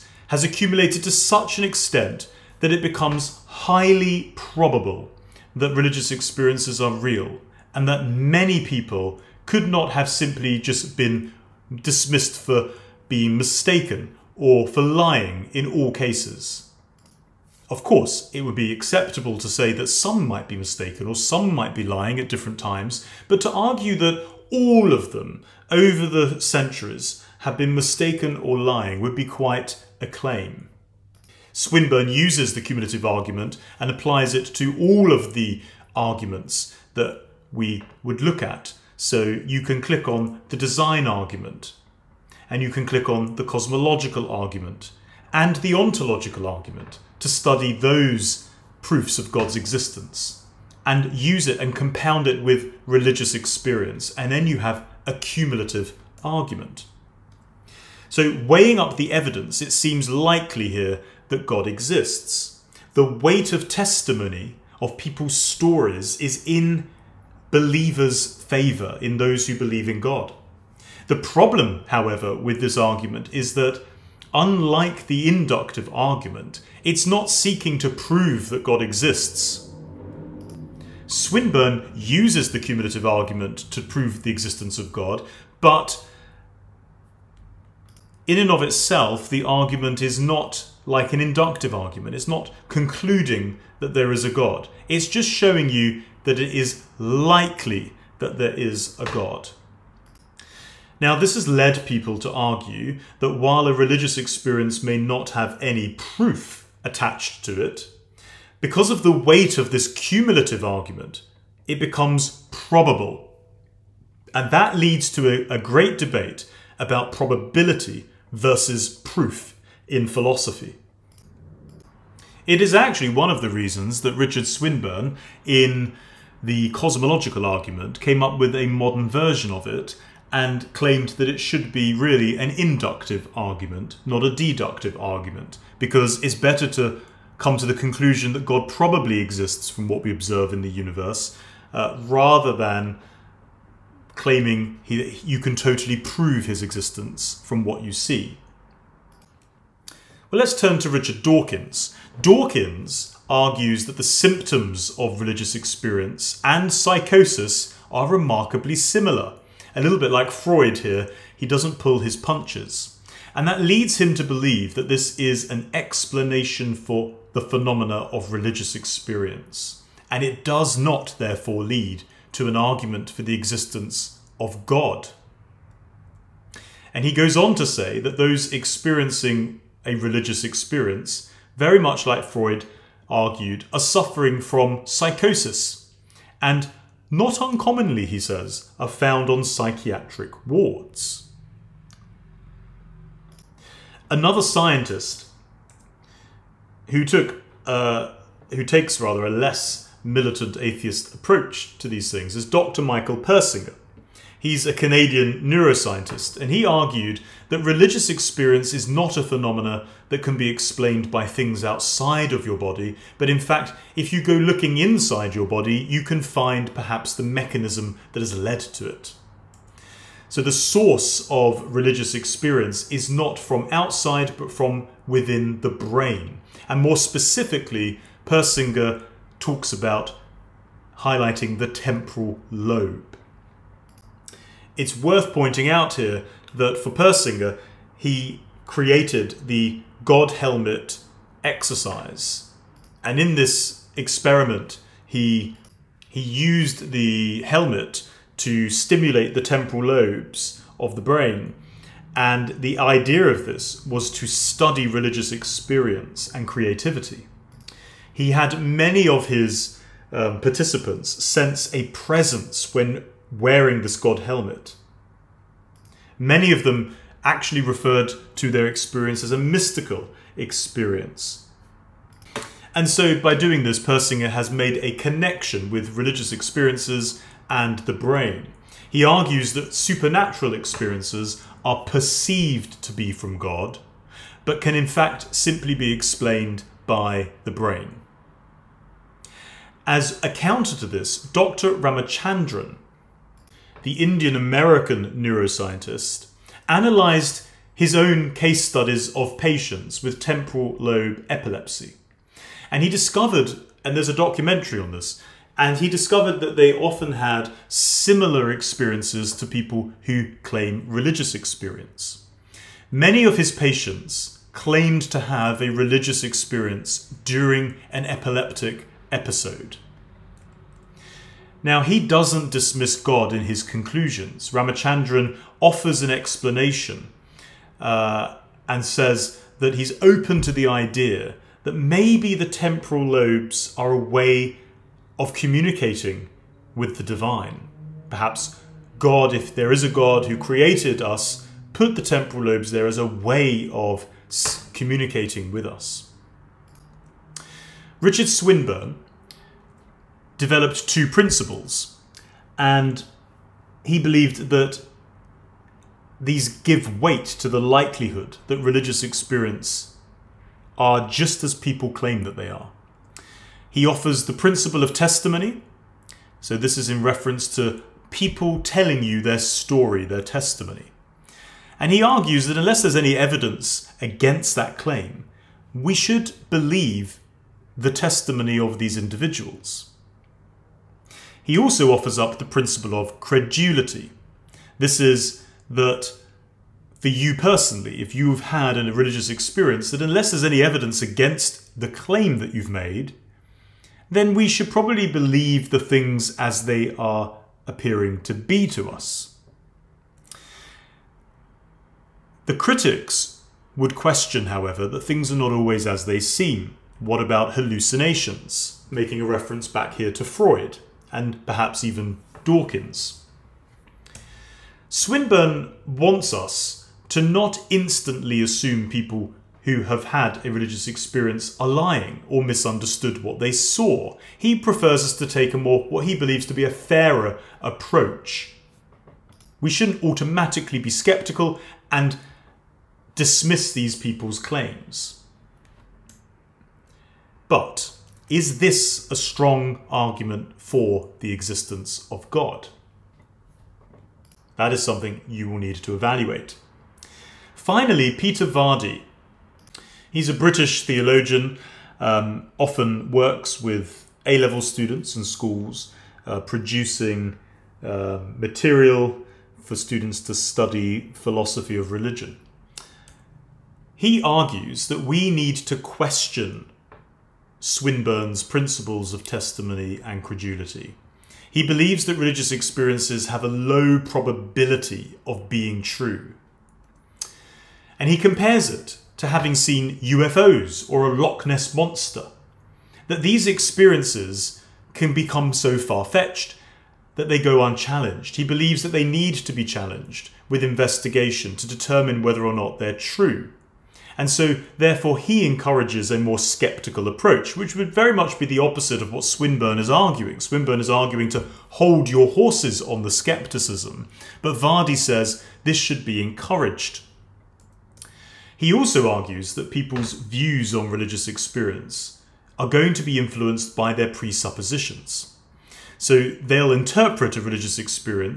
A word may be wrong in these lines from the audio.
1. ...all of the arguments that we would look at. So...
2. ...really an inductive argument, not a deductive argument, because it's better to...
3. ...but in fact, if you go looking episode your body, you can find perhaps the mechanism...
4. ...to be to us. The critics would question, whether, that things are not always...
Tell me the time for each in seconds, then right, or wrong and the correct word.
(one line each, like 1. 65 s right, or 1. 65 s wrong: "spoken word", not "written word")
1. 34 s right
2. 131 s right
3. 213 s wrong: "inside", not "episode"
4. 398 s wrong: "however", not "whether".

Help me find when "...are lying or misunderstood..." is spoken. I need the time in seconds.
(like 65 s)
421 s.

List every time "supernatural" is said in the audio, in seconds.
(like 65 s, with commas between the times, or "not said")
279 s.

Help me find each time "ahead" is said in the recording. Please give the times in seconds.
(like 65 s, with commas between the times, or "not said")
not said.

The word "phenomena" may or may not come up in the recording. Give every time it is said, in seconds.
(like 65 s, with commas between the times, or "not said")
167 s, 209 s.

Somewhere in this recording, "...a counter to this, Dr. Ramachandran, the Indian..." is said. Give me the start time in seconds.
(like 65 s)
290 s.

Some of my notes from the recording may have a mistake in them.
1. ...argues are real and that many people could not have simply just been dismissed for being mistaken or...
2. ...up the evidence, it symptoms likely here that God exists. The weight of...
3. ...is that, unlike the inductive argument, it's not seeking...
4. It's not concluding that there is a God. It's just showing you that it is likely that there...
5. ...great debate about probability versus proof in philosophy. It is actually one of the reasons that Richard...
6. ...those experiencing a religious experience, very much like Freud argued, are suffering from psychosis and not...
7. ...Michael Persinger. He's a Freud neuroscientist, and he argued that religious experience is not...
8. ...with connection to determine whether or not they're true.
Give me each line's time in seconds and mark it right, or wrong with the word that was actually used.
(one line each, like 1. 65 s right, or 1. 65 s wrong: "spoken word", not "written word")
1. 6 s wrong: "experiences", not "argues"
2. 58 s wrong: "seems", not "symptoms"
3. 73 s right
4. 92 s right
5. 115 s right
6. 178 s right
7. 202 s wrong: "Canadian", not "Freud"
8. 490 s wrong: "investigation", not "connection".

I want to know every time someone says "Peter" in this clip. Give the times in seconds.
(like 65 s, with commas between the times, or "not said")
448 s.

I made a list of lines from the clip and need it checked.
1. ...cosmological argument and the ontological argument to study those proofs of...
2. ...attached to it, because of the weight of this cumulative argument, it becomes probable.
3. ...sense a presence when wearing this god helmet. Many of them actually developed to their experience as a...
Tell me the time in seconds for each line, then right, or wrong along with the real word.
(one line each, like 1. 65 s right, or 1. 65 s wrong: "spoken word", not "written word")
1. 43 s right
2. 106 s right
3. 261 s wrong: "referred", not "developed".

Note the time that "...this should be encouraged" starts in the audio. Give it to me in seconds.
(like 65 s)
505 s.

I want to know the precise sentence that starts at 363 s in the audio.
He offers the principle of testimony.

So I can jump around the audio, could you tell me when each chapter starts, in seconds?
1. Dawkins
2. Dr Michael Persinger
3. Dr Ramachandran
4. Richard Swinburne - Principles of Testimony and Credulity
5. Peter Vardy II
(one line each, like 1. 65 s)
1. 150 s
2. 195 s
3. 290 s
4. 347 s
5. 447 s.